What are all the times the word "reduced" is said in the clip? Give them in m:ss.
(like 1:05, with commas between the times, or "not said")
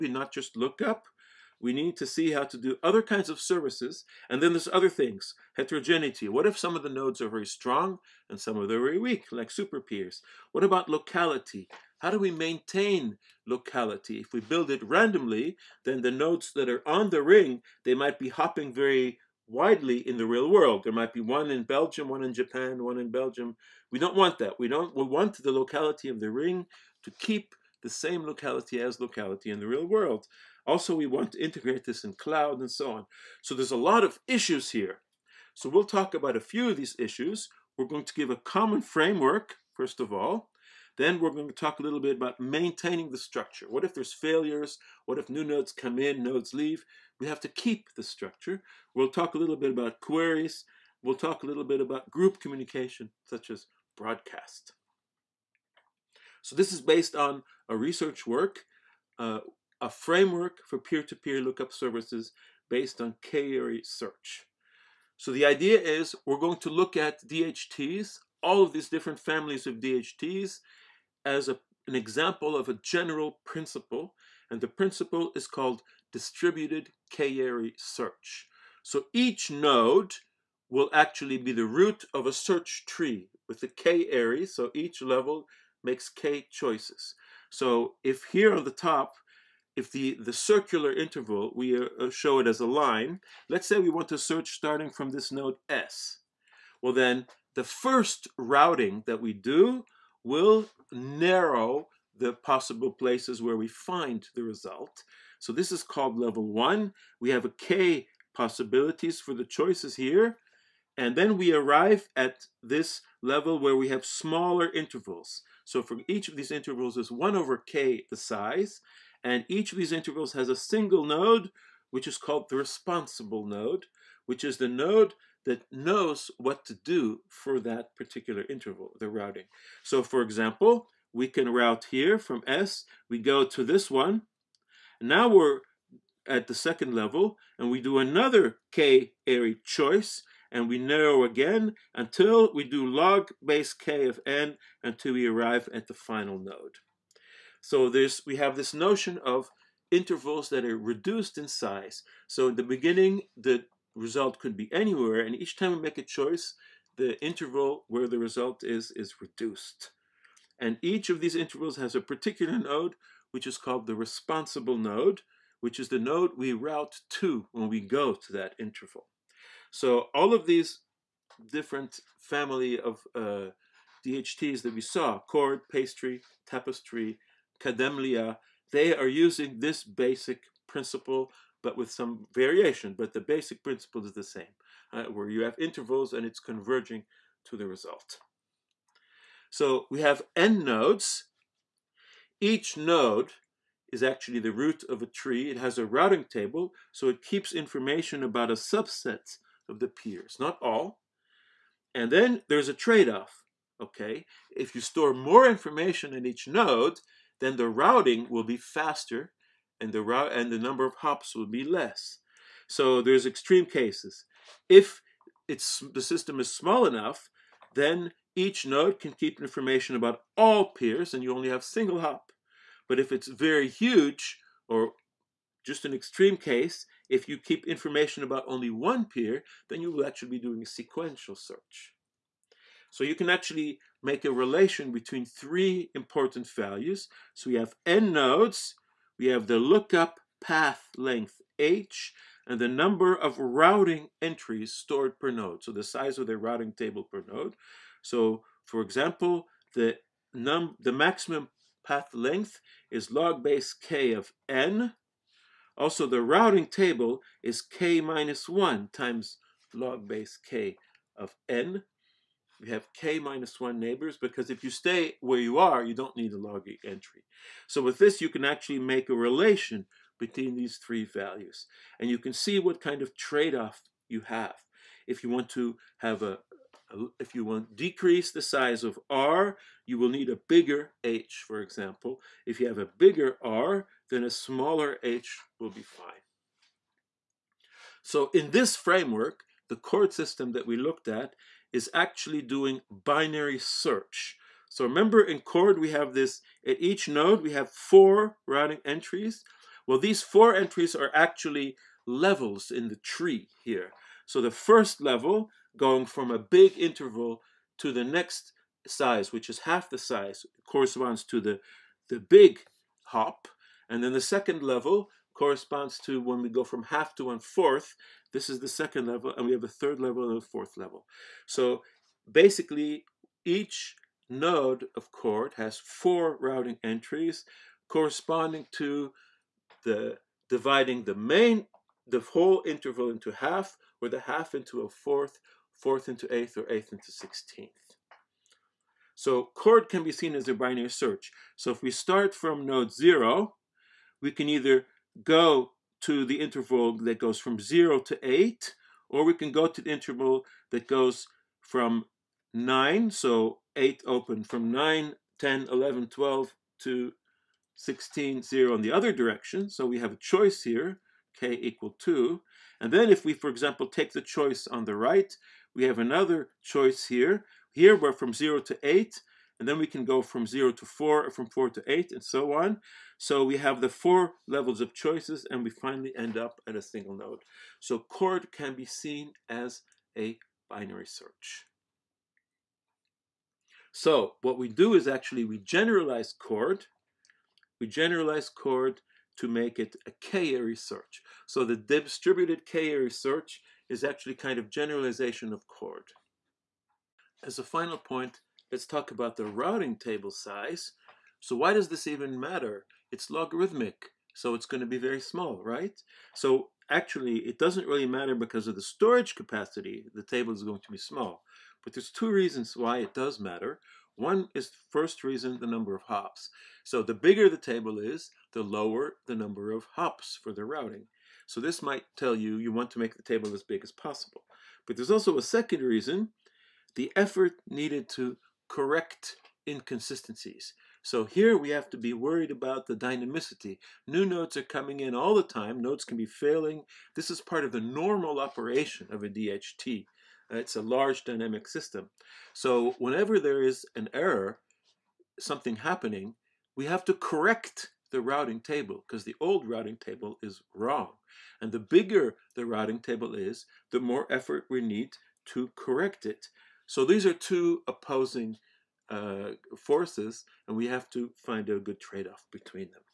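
2:30, 2:39.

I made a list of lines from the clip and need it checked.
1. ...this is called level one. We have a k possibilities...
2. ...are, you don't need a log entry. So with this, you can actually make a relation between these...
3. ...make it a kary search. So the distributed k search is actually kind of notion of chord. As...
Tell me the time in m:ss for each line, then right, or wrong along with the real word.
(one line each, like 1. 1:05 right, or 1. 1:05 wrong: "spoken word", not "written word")
1. 1:45 right
2. 4:25 right
3. 6:29 wrong: "generalization", not "notion".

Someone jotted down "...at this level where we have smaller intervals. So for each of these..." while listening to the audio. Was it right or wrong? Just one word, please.
right.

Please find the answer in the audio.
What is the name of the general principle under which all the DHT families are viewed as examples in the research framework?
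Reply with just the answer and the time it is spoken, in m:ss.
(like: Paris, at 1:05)
distributed query search, at 1:16.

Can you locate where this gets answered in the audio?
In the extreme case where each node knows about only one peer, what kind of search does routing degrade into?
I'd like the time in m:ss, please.
3:50.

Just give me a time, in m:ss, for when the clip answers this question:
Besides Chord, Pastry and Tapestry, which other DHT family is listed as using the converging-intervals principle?
2:57.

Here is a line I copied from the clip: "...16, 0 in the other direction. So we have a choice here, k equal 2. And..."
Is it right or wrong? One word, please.
right.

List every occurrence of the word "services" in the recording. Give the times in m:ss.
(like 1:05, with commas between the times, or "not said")
0:03, 1:01.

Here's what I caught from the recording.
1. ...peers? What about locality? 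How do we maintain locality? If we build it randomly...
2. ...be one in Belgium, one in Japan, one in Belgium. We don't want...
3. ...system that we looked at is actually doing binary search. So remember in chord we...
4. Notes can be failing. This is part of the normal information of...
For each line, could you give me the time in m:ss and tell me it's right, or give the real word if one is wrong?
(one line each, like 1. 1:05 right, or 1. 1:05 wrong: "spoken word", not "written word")
1. 0:09 right
2. 0:21 right
3. 4:50 right
4. 7:15 wrong: "operation", not "information".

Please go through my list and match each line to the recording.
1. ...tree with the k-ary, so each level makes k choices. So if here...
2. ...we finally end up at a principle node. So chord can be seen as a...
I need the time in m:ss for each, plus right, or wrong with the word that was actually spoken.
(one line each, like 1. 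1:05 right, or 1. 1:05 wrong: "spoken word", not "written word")
1. 1:22 right
2. 6:15 wrong: "single", not "principle".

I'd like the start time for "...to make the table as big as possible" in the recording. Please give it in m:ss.
7:02.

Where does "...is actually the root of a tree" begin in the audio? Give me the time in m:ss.
3:13.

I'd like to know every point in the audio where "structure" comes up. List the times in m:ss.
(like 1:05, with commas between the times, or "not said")
0:43, 0:48.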